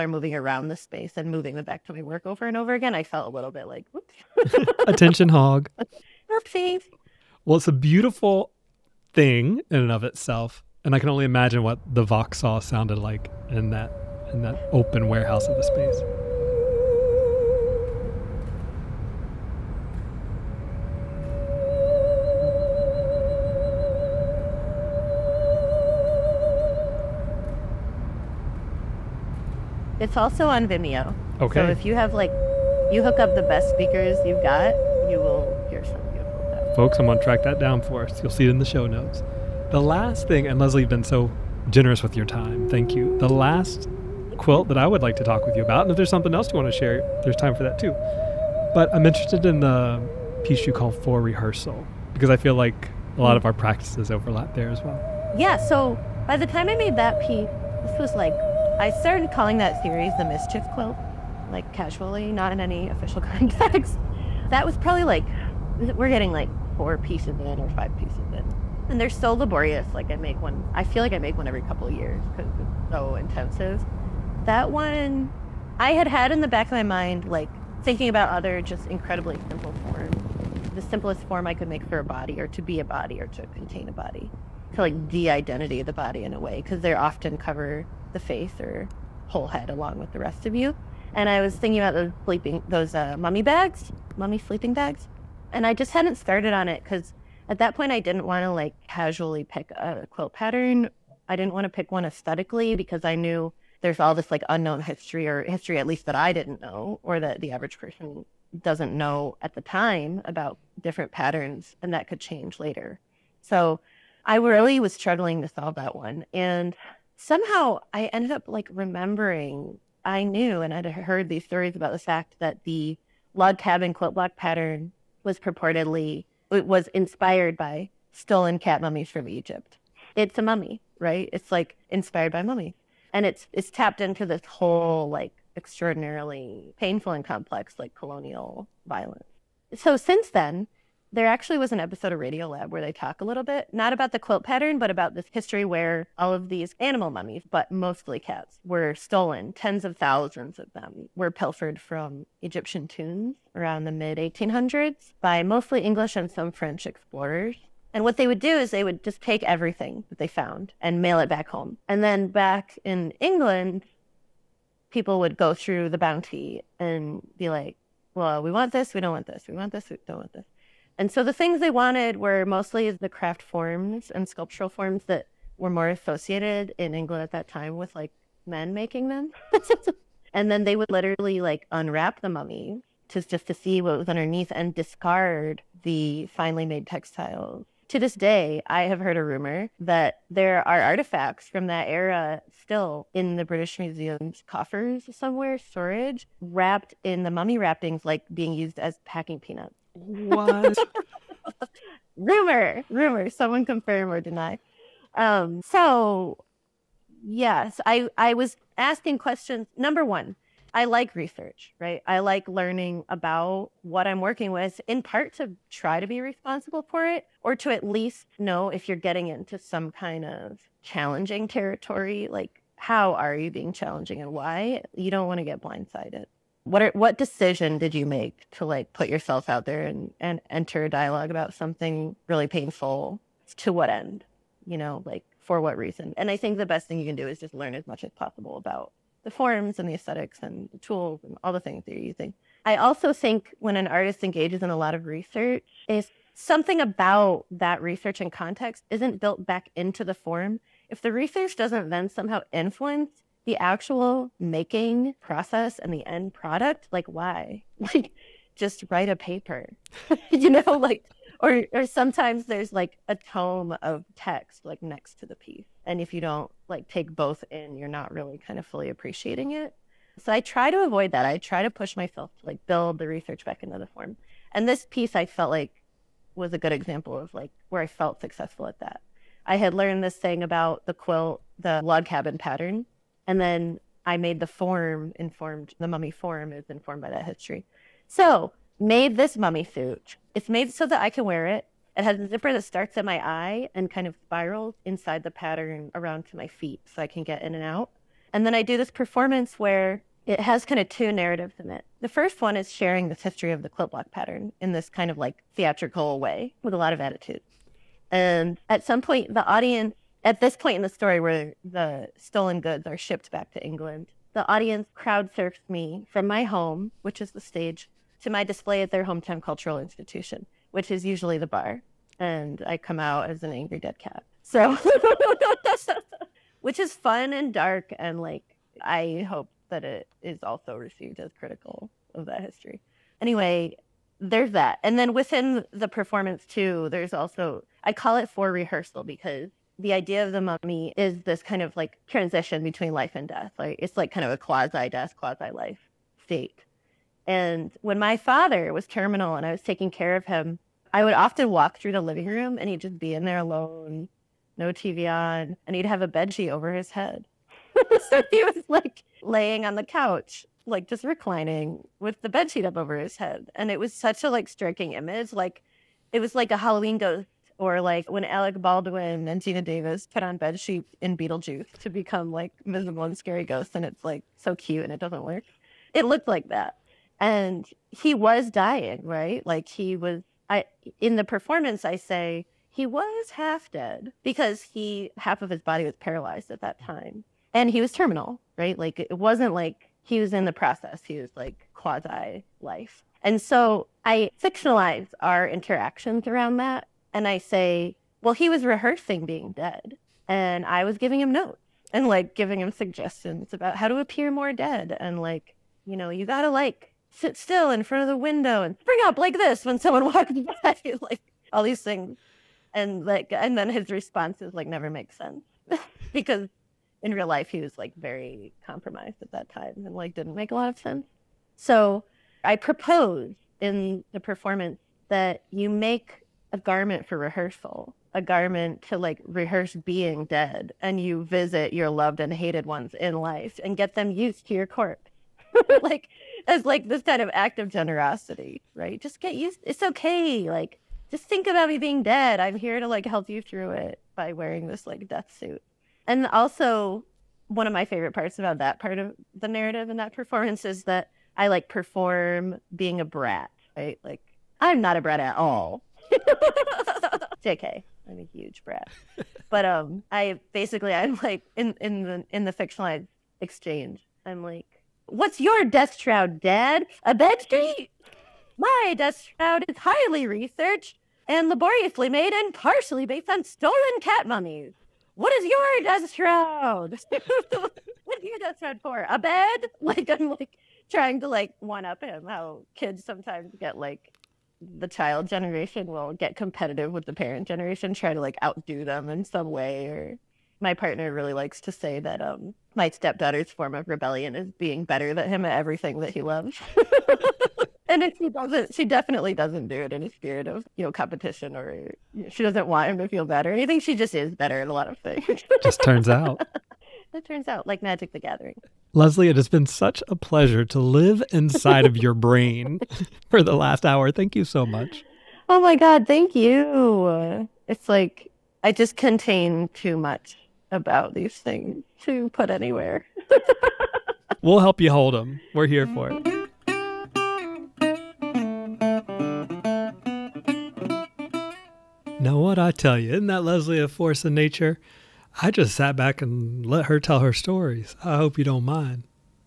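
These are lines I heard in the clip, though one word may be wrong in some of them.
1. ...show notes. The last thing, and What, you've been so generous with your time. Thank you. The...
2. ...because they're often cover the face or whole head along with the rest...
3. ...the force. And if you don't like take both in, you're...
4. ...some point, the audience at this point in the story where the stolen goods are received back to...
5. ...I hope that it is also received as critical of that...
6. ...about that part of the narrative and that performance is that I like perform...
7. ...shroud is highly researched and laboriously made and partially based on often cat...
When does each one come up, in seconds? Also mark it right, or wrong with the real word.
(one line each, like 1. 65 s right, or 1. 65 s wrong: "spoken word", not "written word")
1. 38 s wrong: "Leslie", not "What"
2. 86 s right
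3. 265 s wrong: "piece", not "force"
4. 308 s wrong: "shipped", not "received"
5. 328 s right
6. 448 s right
7. 469 s wrong: "stolen", not "often".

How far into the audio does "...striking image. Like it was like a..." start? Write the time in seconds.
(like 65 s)
364 s.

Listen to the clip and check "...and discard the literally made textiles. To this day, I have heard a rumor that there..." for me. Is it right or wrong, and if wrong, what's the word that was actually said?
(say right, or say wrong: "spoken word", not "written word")
wrong: "finely", not "literally".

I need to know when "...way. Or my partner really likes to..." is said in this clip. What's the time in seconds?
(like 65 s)
489 s.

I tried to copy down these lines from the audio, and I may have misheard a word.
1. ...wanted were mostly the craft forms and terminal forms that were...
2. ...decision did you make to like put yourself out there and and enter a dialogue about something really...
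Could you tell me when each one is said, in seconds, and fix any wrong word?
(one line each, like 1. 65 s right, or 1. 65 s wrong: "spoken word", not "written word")
1. 171 s wrong: "sculptural", not "terminal"
2. 227 s right.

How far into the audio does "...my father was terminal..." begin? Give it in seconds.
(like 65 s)
347 s.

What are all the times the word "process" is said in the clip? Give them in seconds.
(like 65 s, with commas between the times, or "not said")
255 s, 390 s.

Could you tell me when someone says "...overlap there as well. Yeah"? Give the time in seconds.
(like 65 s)
54 s.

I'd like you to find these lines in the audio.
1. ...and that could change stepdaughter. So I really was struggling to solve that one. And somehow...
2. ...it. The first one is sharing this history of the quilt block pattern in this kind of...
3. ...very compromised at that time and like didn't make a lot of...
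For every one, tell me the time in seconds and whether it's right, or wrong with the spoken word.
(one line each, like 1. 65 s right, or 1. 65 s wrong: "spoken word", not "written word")
1. 111 s wrong: "later", not "stepdaughter"
2. 301 s right
3. 417 s right.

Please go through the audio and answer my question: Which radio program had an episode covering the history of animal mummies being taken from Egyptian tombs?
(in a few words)
Radiolab.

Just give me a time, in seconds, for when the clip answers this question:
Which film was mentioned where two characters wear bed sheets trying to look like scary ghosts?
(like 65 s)
371 s.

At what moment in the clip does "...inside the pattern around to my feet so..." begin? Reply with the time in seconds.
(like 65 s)
294 s.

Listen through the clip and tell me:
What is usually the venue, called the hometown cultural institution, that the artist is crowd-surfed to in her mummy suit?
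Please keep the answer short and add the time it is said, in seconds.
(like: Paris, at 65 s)
the bar, at 321 s.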